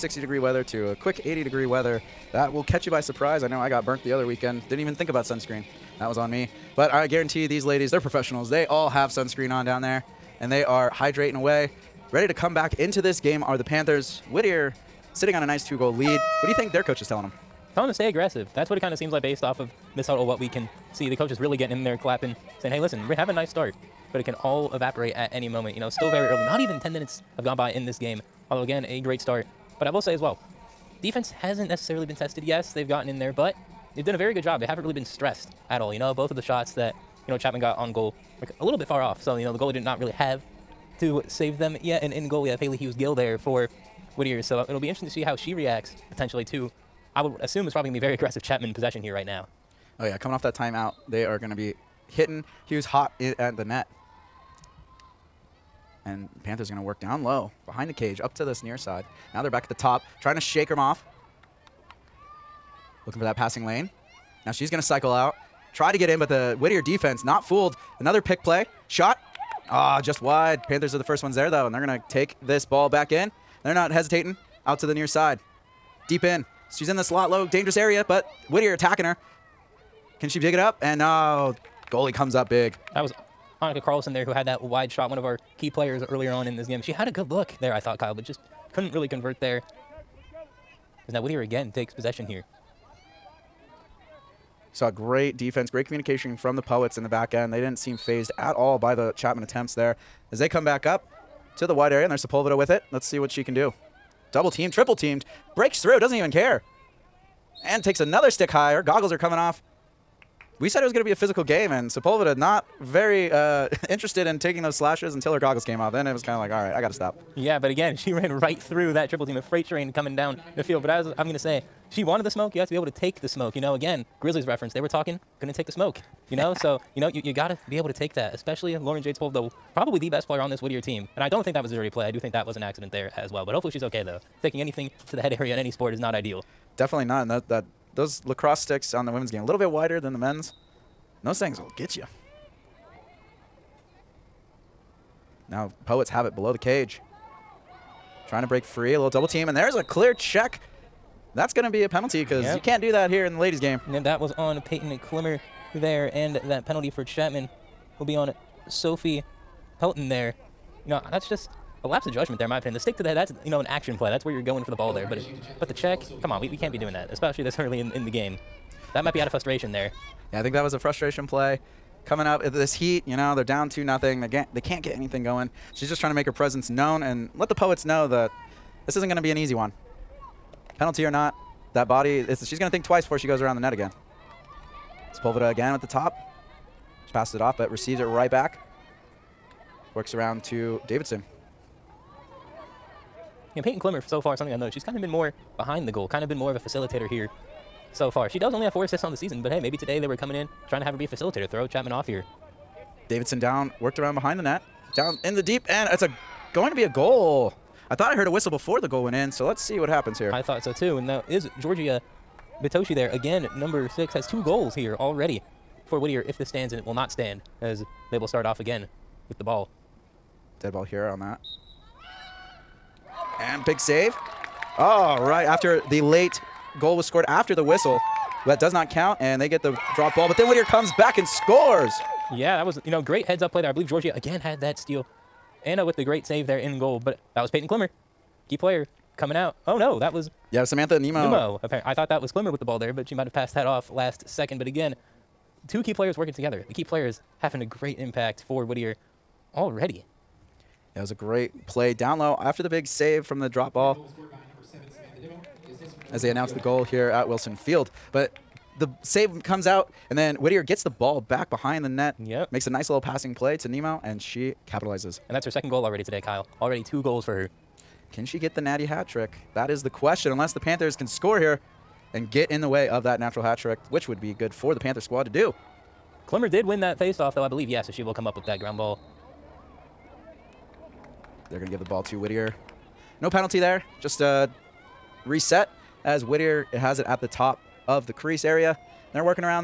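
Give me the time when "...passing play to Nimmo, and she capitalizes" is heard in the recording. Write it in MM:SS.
04:23.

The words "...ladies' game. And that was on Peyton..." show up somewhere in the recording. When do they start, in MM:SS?
02:33.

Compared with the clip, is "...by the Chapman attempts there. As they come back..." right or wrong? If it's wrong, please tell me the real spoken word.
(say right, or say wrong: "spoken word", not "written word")
right.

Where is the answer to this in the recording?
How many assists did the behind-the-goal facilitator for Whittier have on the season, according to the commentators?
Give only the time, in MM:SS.
03:18.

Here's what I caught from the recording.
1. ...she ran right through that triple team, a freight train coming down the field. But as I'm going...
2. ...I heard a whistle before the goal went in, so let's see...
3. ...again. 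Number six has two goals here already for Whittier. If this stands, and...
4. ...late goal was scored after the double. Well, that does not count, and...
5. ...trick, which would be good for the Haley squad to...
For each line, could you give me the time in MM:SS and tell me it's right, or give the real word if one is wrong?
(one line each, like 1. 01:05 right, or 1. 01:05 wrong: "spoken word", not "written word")
1. 01:57 right
2. 03:28 right
3. 03:33 right
4. 03:46 wrong: "whistle", not "double"
5. 04:33 wrong: "Panther", not "Haley".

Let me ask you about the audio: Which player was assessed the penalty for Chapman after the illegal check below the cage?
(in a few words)
Sophie Pelton.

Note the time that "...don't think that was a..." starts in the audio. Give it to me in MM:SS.
02:11.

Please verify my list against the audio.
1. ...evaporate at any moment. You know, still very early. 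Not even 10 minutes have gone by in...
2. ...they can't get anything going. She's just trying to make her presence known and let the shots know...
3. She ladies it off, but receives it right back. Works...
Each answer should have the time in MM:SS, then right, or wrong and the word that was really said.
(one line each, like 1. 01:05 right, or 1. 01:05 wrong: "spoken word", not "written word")
1. 00:24 right
2. 02:54 wrong: "poets", not "shots"
3. 03:07 wrong: "passes", not "ladies".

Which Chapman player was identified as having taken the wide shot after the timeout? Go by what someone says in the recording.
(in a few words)
Annika Carlson.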